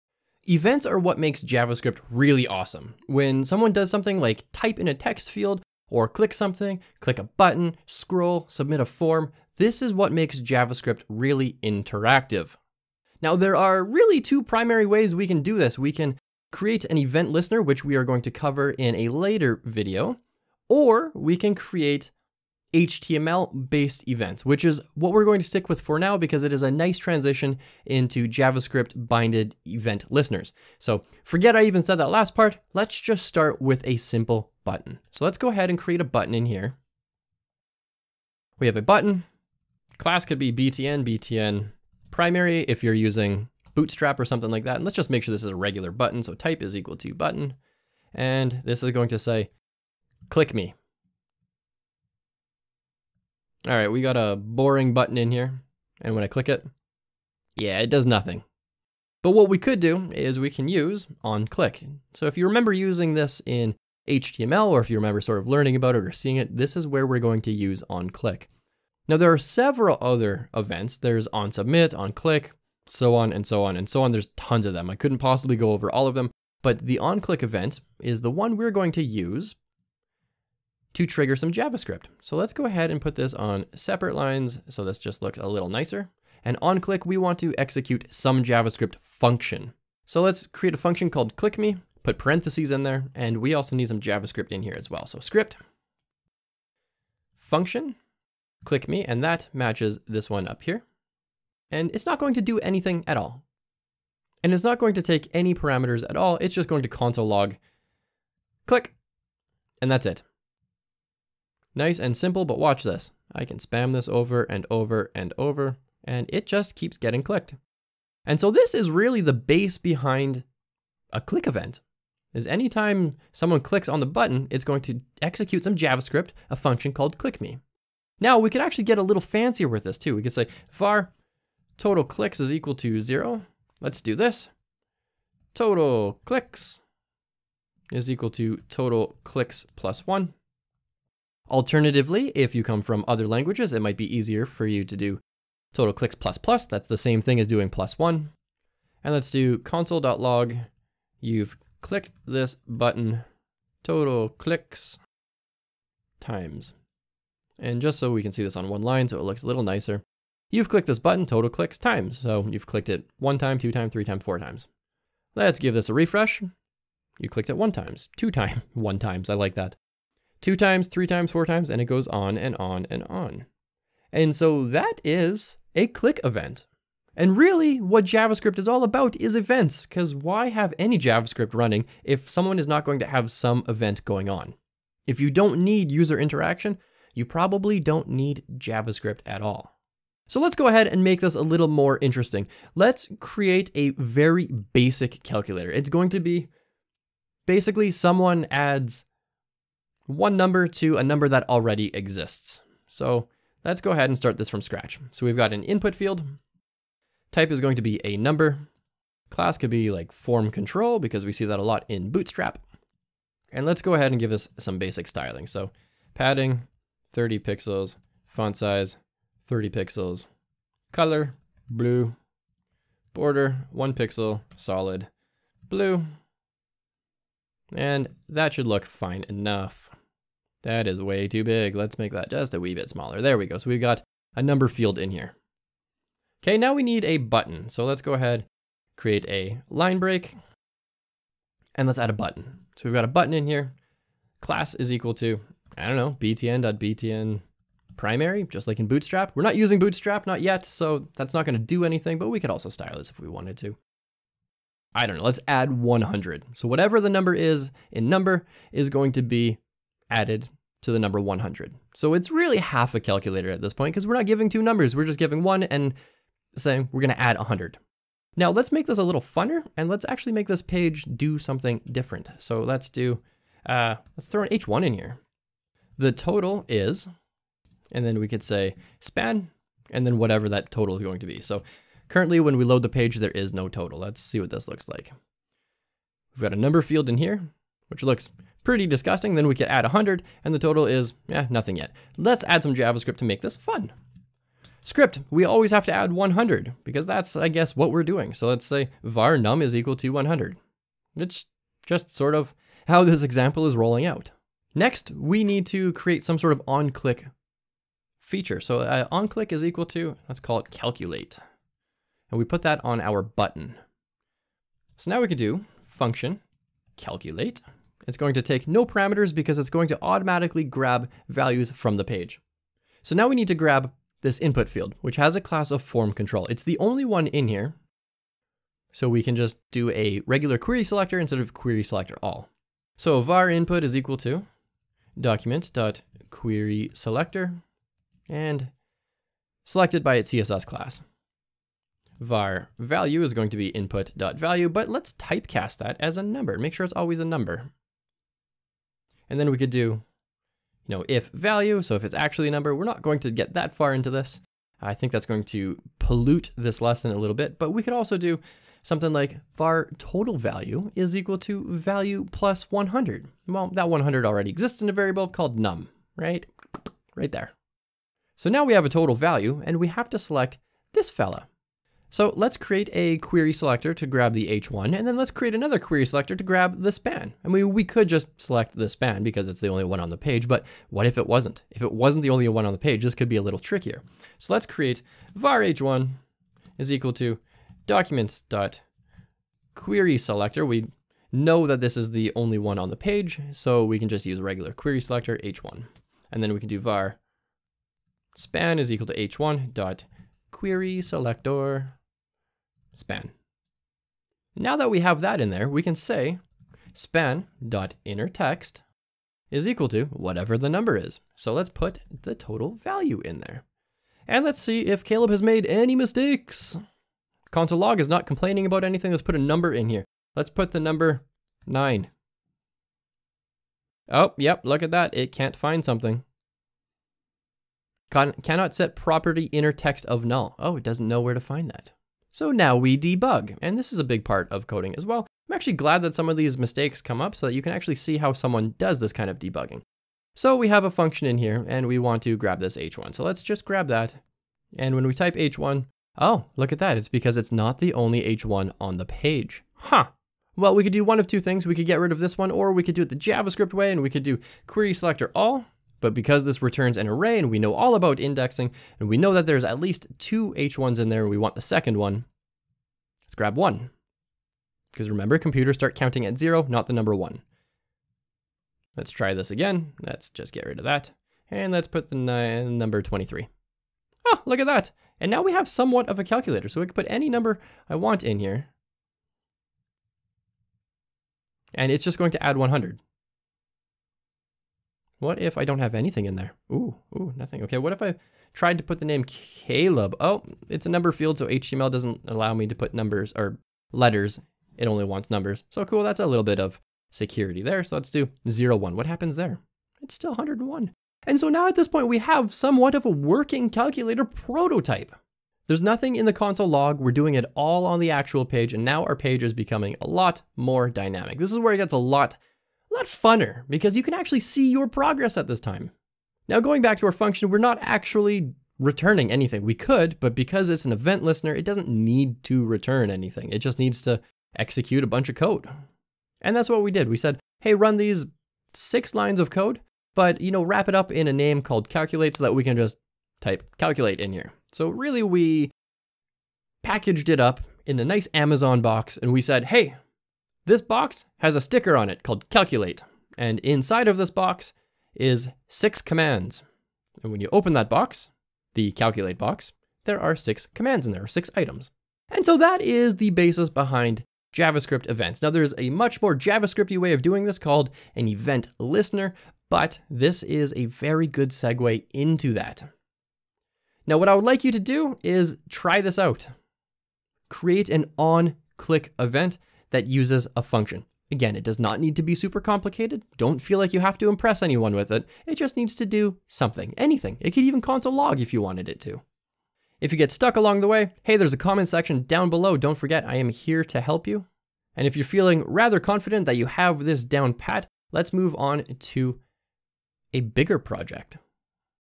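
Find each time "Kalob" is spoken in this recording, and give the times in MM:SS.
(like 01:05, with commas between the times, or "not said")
06:55, 08:09.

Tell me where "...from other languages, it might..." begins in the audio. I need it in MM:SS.
02:22.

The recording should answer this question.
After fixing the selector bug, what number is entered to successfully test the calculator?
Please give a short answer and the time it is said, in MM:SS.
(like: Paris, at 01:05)
23, at 07:52.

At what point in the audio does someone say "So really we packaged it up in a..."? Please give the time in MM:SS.
08:54.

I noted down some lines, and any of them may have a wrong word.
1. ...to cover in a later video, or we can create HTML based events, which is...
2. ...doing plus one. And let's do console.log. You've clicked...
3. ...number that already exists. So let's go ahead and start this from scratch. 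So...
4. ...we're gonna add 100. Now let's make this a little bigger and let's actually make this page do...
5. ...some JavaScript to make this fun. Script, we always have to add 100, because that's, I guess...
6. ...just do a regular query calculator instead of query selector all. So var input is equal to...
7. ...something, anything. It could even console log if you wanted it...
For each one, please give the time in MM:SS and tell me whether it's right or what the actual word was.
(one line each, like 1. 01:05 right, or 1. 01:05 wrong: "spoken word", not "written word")
1. 00:18 right
2. 02:27 right
3. 03:21 right
4. 04:26 wrong: "funner", not "bigger"
5. 04:52 right
6. 05:29 wrong: "selector", not "calculator"
7. 09:36 right.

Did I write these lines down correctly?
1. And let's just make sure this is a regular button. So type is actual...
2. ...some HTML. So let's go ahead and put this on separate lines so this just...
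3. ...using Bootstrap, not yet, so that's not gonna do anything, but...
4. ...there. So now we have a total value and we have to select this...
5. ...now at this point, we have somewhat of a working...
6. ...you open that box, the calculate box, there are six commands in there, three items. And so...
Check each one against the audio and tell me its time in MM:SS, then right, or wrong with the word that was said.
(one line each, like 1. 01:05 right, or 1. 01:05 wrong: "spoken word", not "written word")
1. 00:44 wrong: "equal", not "actual"
2. 01:21 wrong: "JavaScript", not "HTML"
3. 04:09 right
4. 06:07 right
5. 08:21 right
6. 09:07 wrong: "six", not "three".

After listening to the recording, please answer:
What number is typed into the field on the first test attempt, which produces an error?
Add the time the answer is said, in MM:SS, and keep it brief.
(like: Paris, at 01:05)
9, at 07:00.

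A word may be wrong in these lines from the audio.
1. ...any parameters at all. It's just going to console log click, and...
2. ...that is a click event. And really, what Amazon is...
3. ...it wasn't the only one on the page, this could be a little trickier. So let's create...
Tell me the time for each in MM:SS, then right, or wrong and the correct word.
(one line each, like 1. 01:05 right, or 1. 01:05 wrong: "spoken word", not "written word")
1. 01:45 right
2. 02:54 wrong: "JavaScript", not "Amazon"
3. 06:21 right.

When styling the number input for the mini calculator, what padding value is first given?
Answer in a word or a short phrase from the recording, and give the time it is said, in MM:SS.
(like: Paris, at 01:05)
30 pixels, at 03:36.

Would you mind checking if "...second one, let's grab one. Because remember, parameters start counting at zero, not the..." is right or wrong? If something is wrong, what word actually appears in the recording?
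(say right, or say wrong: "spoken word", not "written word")
wrong: "computers", not "parameters".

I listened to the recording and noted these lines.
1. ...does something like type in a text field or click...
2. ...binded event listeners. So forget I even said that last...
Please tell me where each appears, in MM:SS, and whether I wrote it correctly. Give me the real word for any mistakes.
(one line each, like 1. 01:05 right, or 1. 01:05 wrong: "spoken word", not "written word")
1. 00:03 right
2. 00:29 right.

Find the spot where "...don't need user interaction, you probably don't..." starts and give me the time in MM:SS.
03:05.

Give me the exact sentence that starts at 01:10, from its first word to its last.
There's on submit, on click, so on and so on and so on.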